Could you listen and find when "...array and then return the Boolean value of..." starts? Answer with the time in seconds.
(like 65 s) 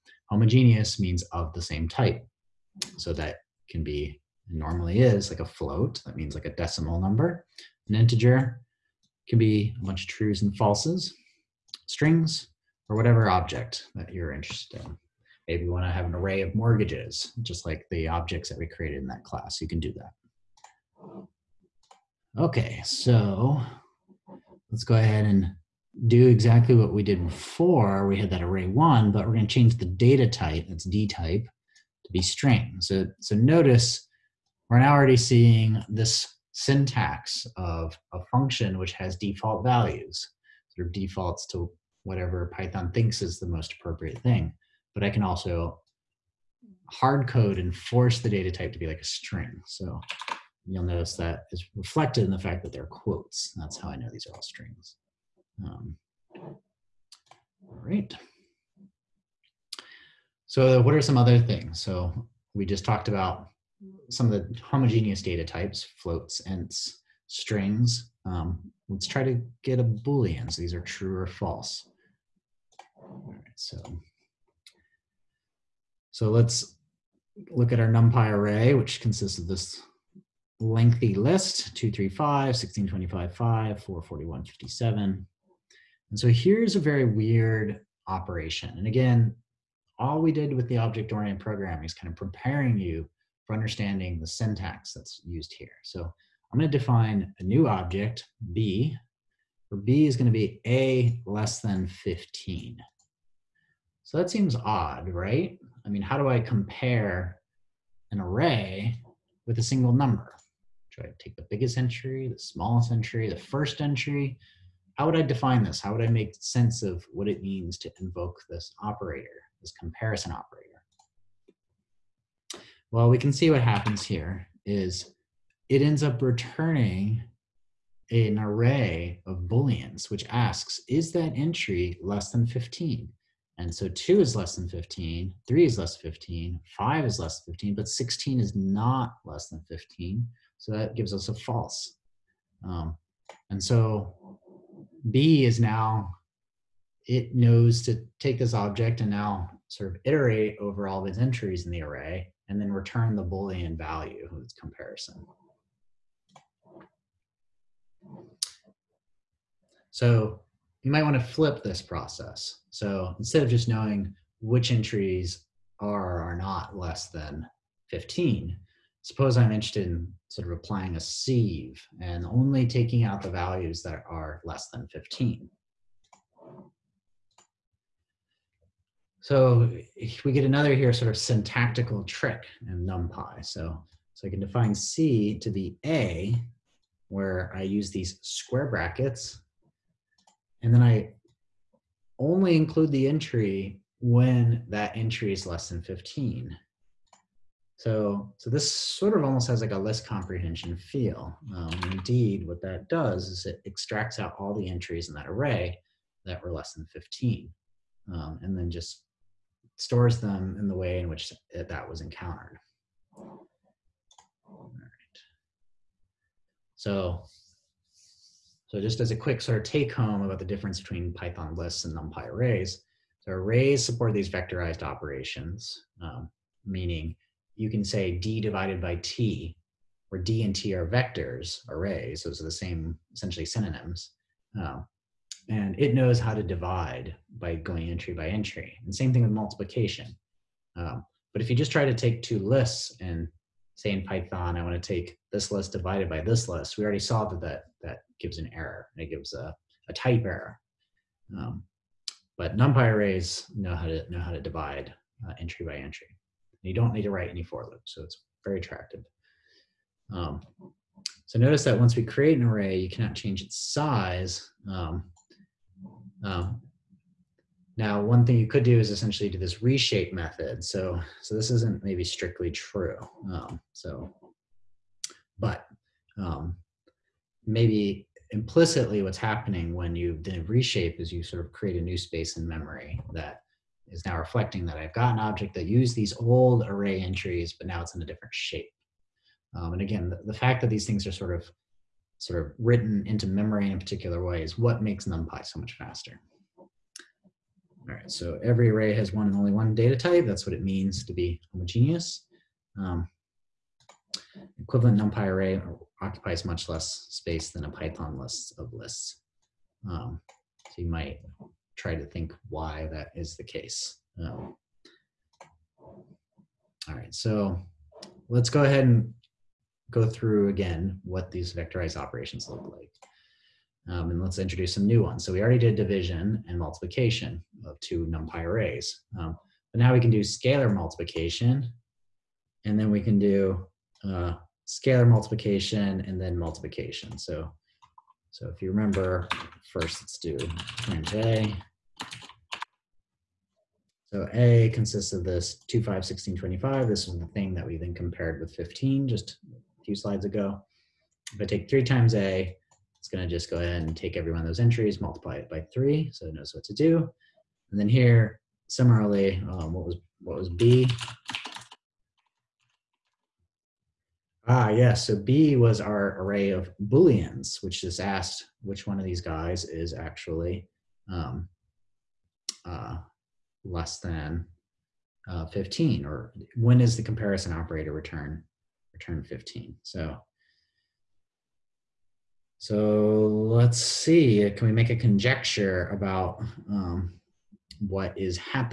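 151 s.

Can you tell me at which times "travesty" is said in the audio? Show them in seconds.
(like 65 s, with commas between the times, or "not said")
not said.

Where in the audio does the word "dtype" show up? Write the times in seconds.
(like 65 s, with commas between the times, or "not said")
30 s.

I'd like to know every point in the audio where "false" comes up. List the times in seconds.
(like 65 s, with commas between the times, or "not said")
10 s, 71 s, 141 s.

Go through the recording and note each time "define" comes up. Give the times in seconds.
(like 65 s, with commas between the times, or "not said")
96 s, 115 s, 184 s.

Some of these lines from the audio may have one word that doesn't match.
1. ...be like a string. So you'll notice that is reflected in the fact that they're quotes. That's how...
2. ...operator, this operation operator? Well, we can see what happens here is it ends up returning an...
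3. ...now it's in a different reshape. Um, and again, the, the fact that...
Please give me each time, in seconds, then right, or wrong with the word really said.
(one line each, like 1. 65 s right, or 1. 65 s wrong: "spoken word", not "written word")
1. 48 s right
2. 118 s wrong: "comparison", not "operation"
3. 287 s wrong: "shape", not "reshape".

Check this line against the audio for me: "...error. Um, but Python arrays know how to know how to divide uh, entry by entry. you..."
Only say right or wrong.
wrong.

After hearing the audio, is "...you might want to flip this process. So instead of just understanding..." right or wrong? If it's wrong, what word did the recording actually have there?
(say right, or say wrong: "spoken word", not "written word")
wrong: "knowing", not "understanding".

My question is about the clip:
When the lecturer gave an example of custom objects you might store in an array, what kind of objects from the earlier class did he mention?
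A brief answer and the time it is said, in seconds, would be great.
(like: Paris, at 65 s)
Mortgages, at 16 s.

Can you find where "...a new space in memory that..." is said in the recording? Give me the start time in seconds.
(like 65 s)
281 s.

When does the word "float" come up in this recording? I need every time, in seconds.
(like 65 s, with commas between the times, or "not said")
5 s, 65 s.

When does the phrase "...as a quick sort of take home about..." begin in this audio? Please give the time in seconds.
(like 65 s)
218 s.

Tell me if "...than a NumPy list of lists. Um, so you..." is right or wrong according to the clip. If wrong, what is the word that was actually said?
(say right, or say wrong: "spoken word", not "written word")
wrong: "Python", not "NumPy".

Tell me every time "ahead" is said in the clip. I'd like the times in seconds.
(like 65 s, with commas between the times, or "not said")
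24 s, 318 s, 353 s.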